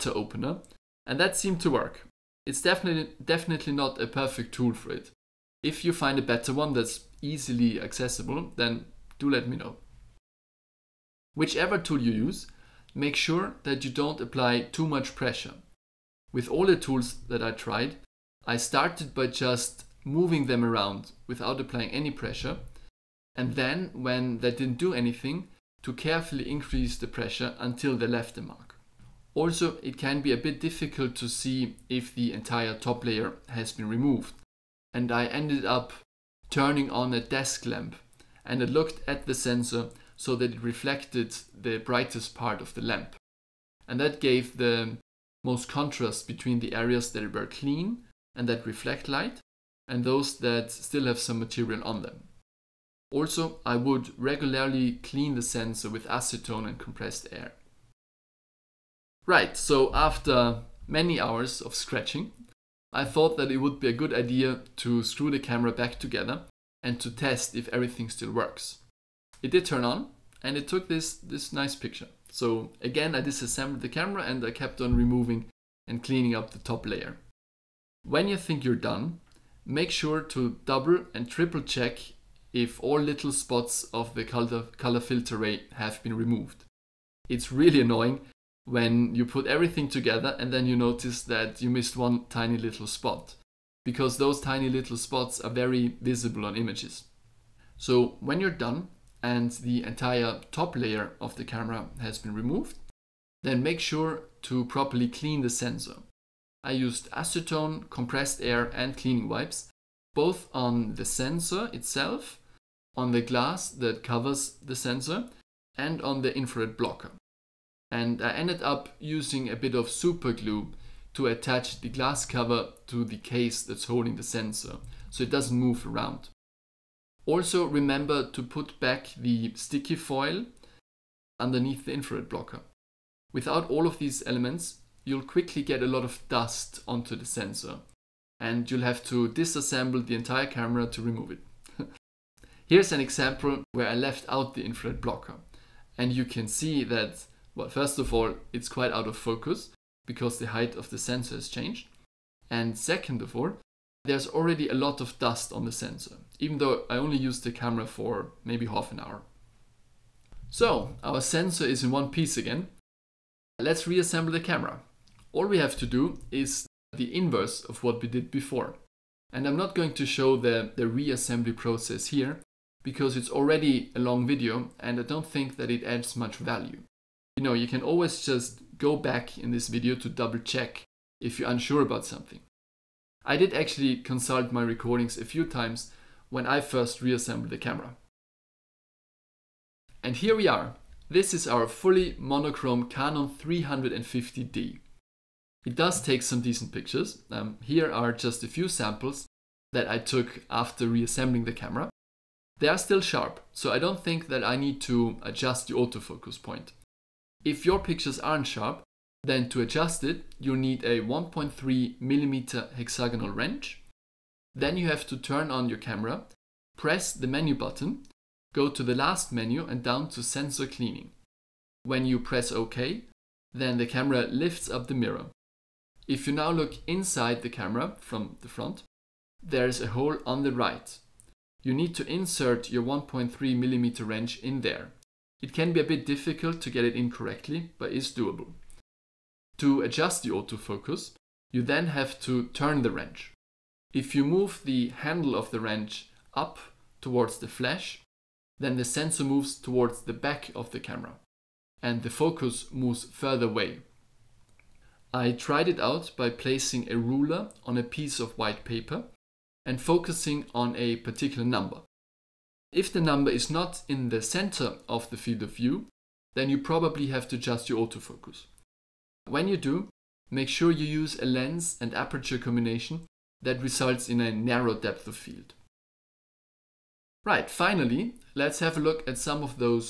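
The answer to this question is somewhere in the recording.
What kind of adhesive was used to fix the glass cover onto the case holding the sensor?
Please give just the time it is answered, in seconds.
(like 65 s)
119 s.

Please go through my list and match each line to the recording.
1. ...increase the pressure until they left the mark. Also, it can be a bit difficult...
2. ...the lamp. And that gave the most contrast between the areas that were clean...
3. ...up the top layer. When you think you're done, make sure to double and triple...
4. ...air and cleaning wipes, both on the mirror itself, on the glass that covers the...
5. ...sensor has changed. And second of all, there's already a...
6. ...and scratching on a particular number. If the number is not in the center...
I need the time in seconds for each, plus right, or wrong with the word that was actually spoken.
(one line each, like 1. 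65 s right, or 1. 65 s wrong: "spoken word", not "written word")
1. 26 s right
2. 42 s right
3. 76 s right
4. 108 s wrong: "sensor", not "mirror"
5. 150 s right
6. 259 s wrong: "focusing", not "scratching".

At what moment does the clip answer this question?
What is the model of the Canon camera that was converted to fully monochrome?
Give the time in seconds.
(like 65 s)
192 s.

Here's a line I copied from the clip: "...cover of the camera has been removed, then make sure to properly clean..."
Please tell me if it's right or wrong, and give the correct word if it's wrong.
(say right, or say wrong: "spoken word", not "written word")
wrong: "layer", not "cover".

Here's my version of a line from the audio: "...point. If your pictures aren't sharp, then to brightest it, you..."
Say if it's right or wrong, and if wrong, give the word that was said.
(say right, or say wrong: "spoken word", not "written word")
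wrong: "adjust", not "brightest".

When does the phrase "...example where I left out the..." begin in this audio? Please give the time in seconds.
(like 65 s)
143 s.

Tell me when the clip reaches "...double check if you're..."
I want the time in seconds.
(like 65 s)
180 s.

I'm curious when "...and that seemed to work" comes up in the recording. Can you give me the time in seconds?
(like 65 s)
1 s.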